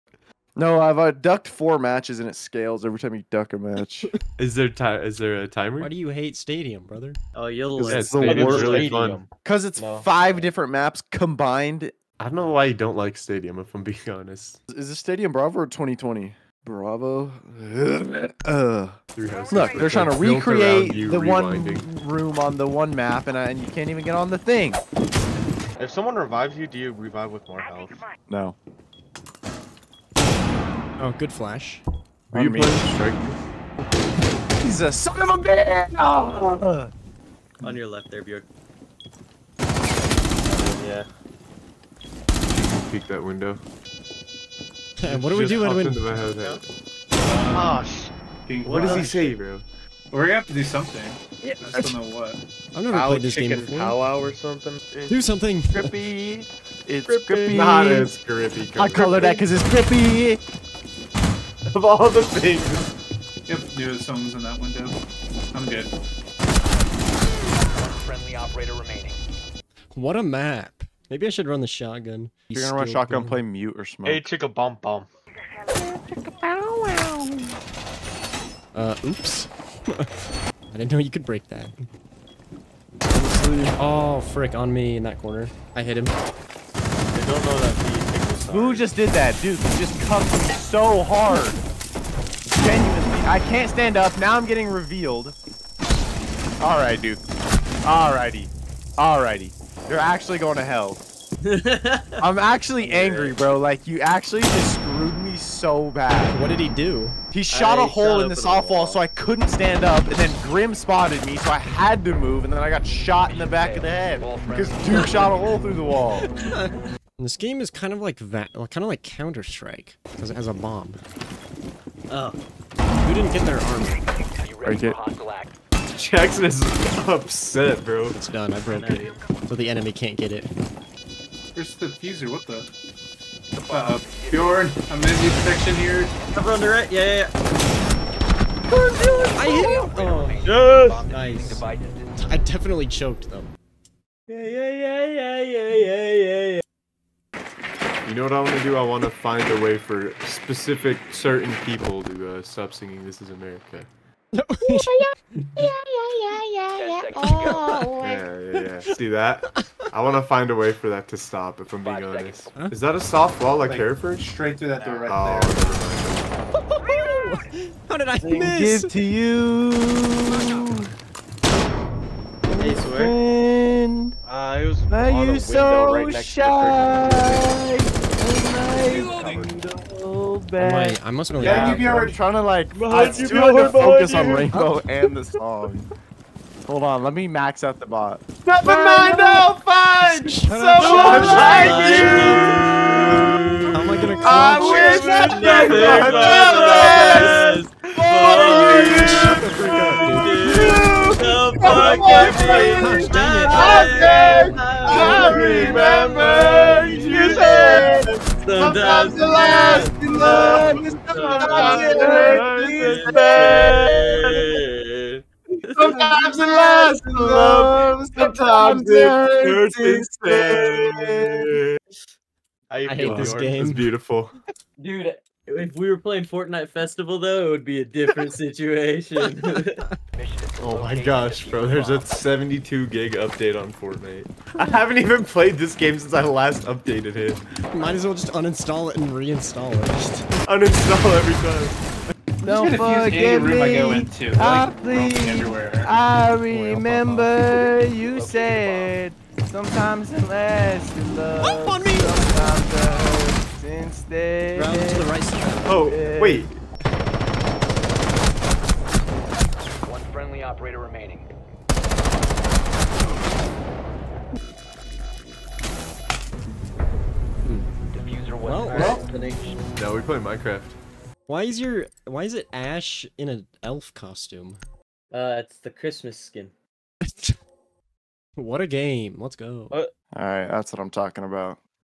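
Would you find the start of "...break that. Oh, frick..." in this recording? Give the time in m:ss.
1:21.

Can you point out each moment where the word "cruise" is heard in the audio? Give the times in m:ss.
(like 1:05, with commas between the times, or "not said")
not said.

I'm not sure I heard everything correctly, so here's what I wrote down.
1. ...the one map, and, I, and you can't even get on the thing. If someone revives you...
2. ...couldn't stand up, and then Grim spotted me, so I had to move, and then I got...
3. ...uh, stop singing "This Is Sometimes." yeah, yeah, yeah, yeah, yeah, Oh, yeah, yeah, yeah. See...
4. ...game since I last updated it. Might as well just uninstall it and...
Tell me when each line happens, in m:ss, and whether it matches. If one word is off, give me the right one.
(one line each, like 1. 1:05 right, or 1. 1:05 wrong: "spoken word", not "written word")
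1. 0:22 right
2. 1:49 right
3. 2:32 wrong: "America", not "Sometimes"
4. 3:55 right.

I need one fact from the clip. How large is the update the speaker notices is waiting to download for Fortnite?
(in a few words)
72 gig.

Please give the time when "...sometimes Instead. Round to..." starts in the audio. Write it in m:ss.
4:11.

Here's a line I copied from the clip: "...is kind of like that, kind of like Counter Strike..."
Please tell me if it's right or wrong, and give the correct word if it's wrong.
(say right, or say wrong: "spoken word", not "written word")
right.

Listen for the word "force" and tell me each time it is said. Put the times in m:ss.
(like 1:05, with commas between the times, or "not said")
not said.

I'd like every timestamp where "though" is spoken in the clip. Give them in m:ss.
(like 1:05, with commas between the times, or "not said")
2:23, 3:47.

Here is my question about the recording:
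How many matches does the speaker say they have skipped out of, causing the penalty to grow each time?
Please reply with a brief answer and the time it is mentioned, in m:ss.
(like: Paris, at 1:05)
4, at 0:01.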